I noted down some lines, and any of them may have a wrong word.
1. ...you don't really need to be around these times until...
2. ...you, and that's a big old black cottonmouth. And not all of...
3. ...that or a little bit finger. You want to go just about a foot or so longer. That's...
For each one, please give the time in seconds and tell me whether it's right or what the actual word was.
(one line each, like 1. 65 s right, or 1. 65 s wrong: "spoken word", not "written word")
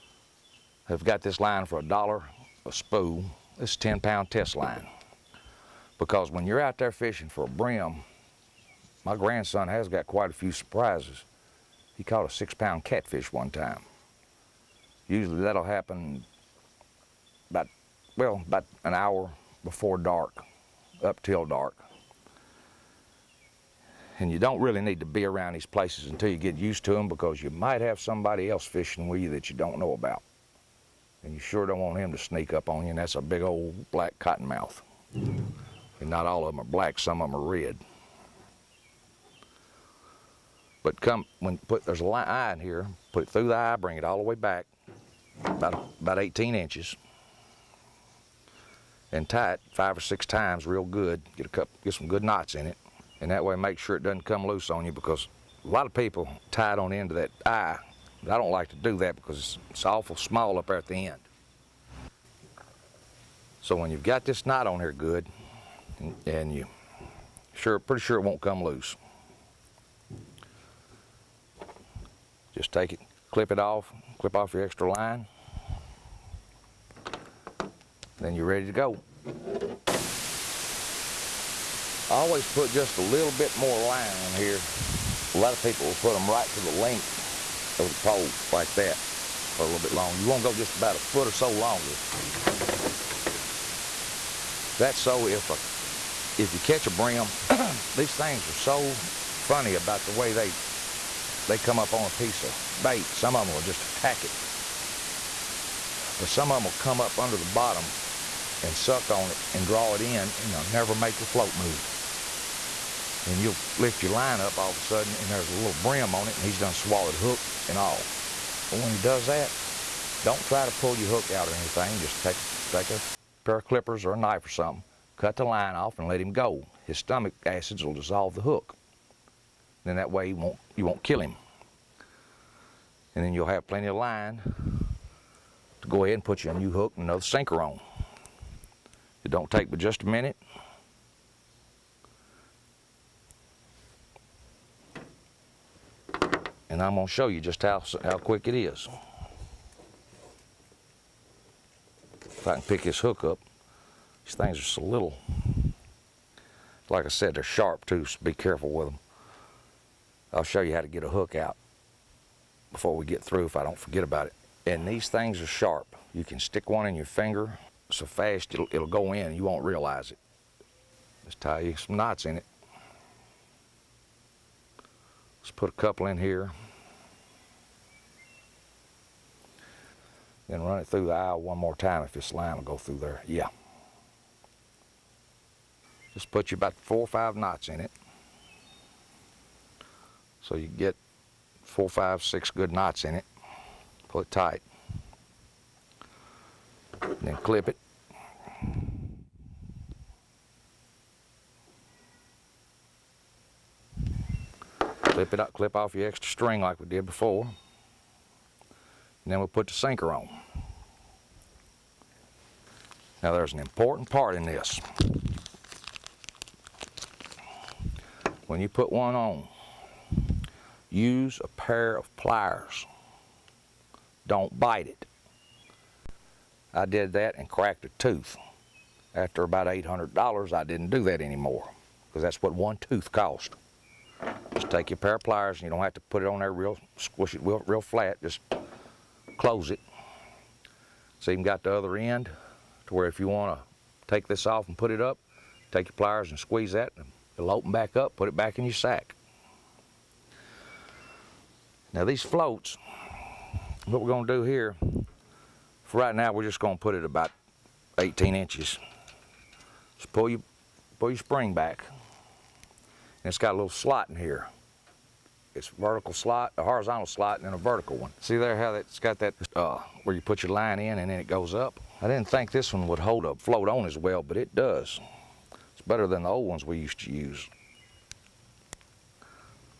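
1. 24 s wrong: "places", not "times"
2. 32 s right
3. 88 s wrong: "longer", not "finger".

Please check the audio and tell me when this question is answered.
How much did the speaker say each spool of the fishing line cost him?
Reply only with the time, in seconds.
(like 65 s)
1 s.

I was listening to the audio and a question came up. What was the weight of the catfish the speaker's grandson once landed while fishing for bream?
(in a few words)
6 pounds.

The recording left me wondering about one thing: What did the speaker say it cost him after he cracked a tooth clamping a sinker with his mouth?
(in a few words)
$800.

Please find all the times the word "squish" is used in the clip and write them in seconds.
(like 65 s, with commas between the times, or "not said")
236 s.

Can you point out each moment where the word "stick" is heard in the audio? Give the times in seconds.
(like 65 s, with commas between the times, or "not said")
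166 s.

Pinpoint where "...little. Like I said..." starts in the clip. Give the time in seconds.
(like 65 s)
154 s.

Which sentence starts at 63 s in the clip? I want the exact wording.
So when you've got this knot on here good, and, and you sure, pretty sure it won't come loose.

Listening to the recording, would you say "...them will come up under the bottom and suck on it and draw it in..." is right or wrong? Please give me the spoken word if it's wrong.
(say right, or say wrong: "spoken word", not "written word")
right.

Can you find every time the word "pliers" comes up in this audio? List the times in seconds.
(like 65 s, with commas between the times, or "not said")
222 s, 235 s, 245 s.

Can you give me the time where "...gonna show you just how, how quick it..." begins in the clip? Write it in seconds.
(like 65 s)
146 s.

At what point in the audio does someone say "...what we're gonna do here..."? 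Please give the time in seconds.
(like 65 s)
253 s.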